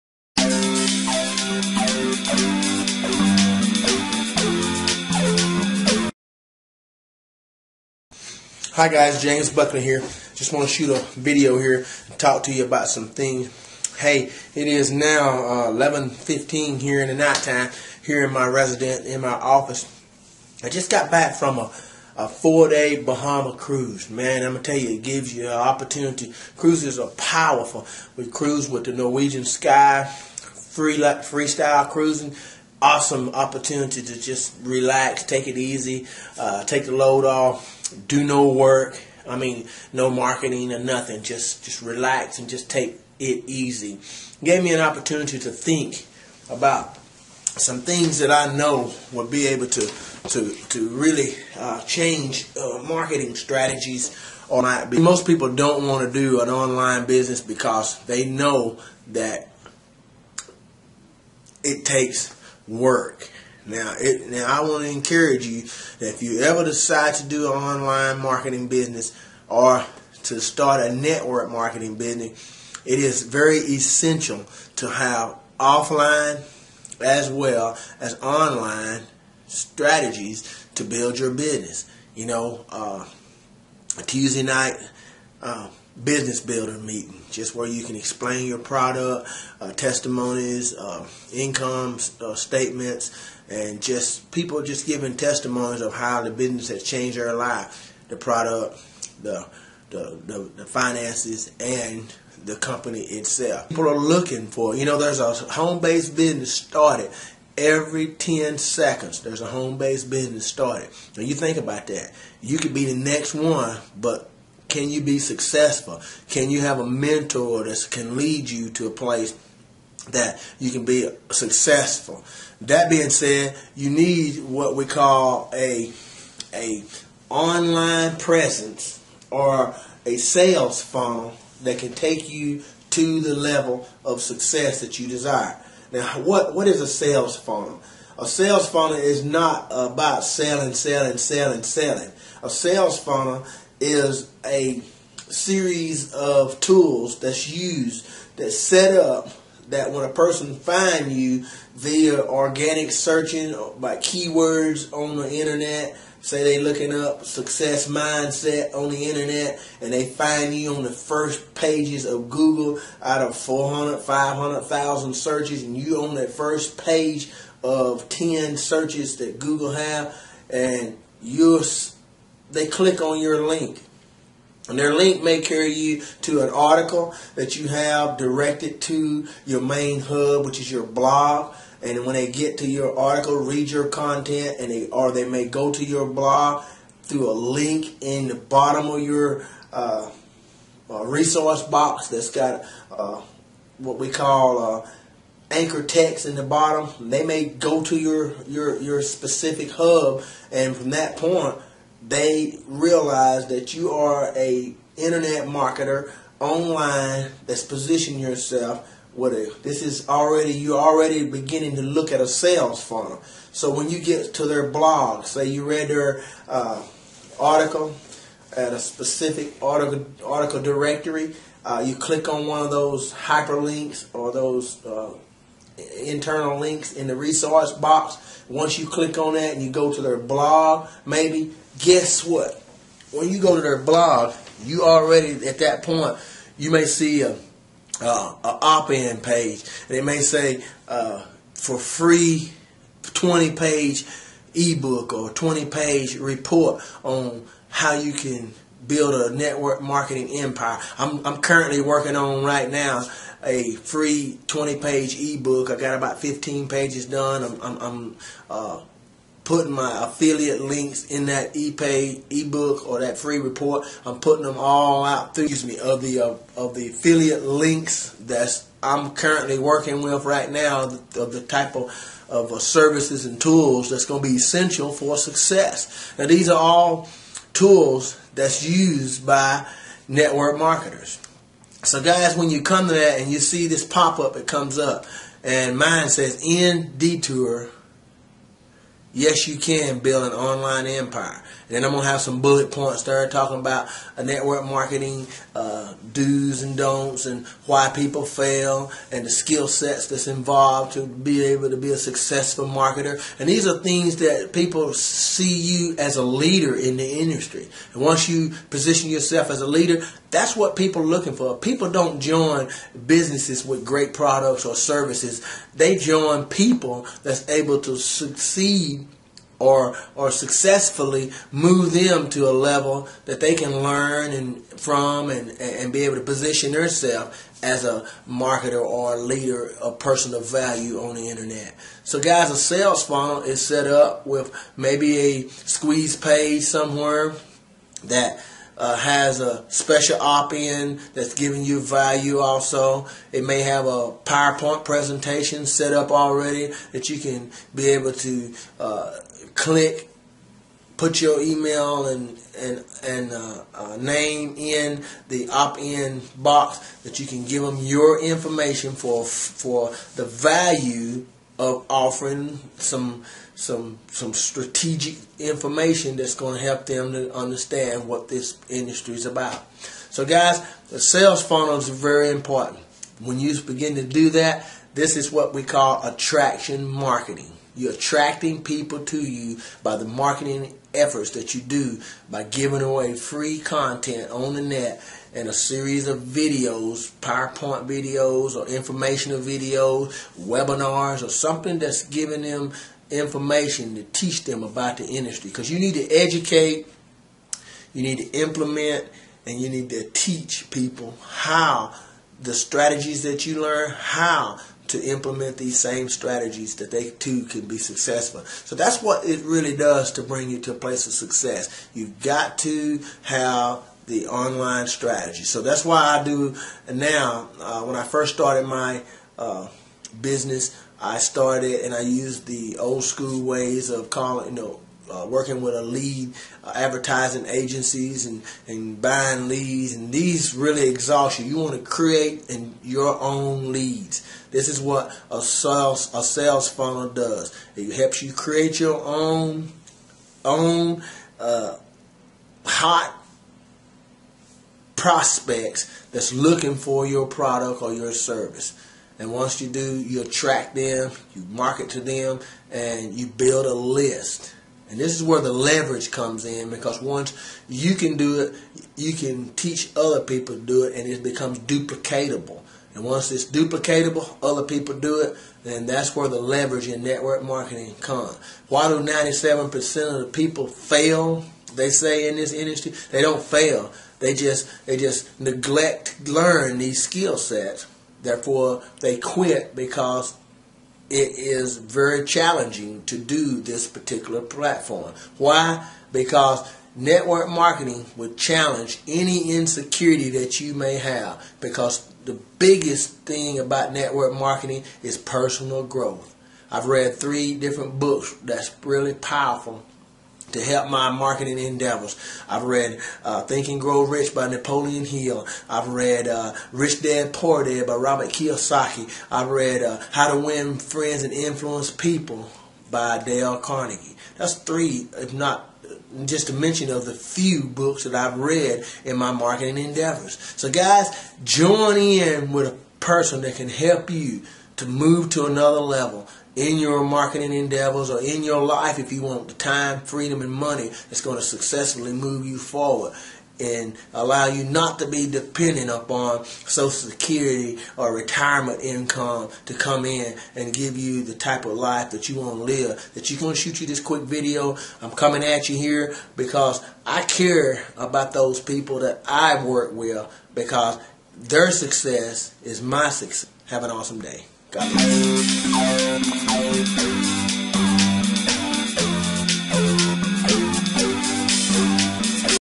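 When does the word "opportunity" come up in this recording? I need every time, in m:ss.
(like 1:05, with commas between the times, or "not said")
0:25, 0:33, 0:44.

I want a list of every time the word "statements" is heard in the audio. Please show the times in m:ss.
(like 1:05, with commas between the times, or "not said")
1:32.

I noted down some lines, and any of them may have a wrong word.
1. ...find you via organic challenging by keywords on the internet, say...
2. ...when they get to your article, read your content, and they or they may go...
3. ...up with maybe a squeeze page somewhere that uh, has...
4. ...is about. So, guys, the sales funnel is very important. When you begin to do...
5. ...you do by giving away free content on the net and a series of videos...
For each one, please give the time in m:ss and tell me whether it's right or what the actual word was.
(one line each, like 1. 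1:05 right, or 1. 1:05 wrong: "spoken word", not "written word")
1. 2:30 wrong: "searching", not "challenging"
2. 3:02 right
3. 5:33 right
4. 6:09 right
5. 6:21 right.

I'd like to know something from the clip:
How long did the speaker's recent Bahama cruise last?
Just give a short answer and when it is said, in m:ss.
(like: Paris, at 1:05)
4 days, at 0:22.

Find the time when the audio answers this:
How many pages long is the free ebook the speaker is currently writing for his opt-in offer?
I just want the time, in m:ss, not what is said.
4:14.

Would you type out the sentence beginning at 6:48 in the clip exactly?
So that's what it really does to bring you to a place of success.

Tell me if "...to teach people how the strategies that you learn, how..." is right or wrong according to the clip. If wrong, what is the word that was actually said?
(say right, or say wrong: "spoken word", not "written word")
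right.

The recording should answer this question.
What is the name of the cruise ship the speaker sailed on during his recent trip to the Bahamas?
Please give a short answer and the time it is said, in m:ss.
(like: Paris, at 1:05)
Norwegian Sky, at 0:28.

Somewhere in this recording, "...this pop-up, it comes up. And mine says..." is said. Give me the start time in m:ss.
4:43.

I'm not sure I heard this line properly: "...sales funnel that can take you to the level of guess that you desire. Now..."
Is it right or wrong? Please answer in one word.
wrong.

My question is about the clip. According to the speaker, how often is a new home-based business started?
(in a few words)
every 10 seconds.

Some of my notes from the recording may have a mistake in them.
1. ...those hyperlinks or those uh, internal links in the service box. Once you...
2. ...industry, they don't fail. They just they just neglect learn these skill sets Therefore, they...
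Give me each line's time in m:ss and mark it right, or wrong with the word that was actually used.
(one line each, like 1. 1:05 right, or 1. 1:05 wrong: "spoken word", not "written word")
1. 3:42 wrong: "resource", not "service"
2. 7:52 right.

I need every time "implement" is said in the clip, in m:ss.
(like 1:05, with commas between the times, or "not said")
6:38, 6:45.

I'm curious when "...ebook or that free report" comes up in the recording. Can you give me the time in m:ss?
4:22.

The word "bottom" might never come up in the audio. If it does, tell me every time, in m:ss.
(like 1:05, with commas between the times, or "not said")
3:08, 3:16.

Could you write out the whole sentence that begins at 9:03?
That you going to shoot you this quick video.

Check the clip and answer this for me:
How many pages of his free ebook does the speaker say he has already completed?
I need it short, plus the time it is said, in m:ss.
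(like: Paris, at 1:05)
15, at 4:16.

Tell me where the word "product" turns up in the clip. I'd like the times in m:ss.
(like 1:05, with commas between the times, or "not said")
1:28, 1:38, 5:14, 7:27.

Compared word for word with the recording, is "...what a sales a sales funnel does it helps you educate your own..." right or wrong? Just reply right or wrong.
wrong.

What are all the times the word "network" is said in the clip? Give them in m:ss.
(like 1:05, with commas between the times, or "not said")
1:10, 4:09, 4:40, 4:54, 7:47, 8:06, 8:13.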